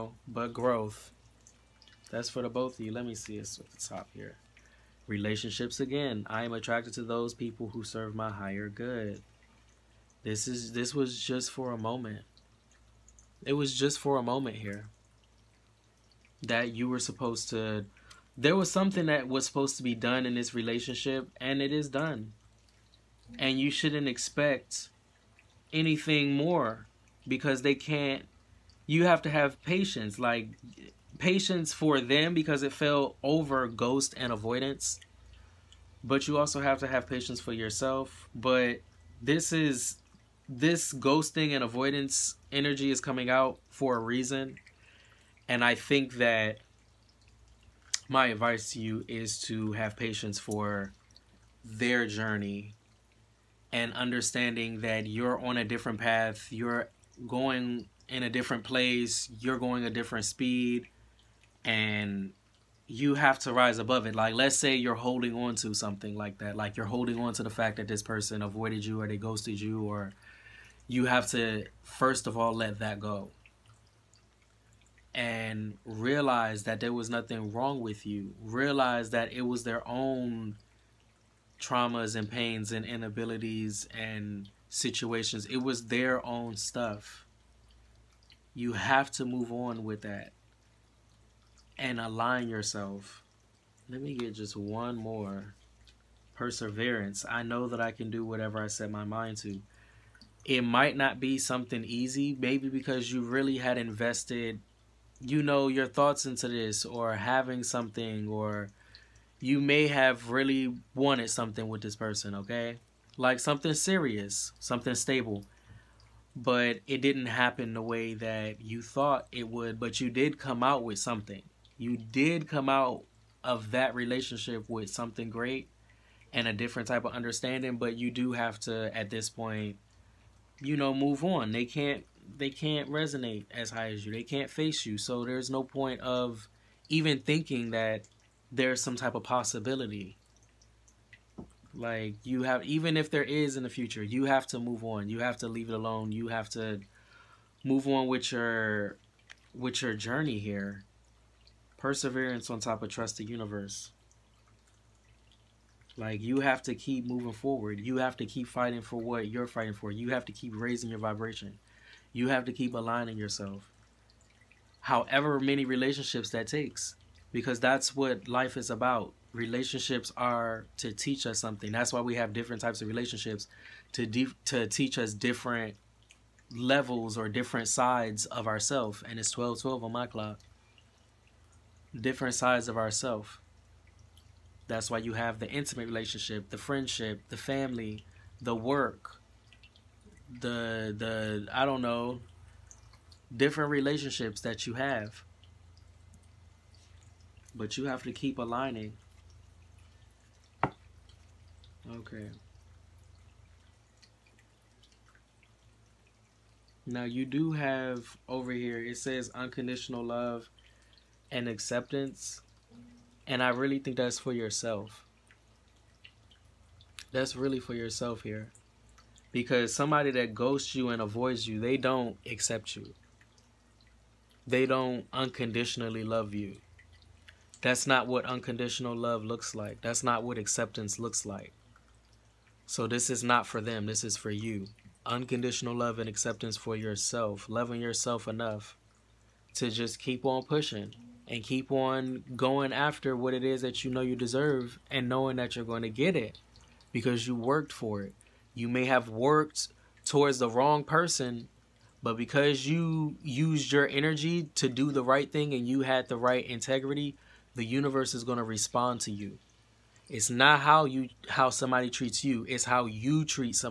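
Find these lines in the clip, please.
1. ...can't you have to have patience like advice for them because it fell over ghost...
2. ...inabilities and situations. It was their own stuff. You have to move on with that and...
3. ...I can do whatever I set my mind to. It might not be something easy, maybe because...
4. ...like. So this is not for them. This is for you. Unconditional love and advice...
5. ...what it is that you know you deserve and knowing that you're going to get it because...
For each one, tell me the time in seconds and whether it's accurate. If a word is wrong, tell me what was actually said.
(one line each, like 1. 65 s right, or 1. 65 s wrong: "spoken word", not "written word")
1. 27 s wrong: "patience", not "advice"
2. 82 s right
3. 97 s right
4. 231 s wrong: "acceptance", not "advice"
5. 243 s right.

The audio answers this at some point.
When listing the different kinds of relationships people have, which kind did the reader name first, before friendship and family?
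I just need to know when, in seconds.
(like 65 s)
185 s.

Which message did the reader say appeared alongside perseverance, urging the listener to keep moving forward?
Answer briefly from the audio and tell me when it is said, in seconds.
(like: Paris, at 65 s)
Trust the universe, at 152 s.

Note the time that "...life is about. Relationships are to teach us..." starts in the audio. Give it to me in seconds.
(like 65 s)
168 s.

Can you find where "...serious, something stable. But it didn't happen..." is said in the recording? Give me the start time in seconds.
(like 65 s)
113 s.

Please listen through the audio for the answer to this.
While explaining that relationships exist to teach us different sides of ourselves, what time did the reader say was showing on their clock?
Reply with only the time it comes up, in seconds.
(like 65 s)
179 s.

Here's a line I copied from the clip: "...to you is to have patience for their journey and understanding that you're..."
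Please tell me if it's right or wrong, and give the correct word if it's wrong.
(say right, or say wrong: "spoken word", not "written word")
right.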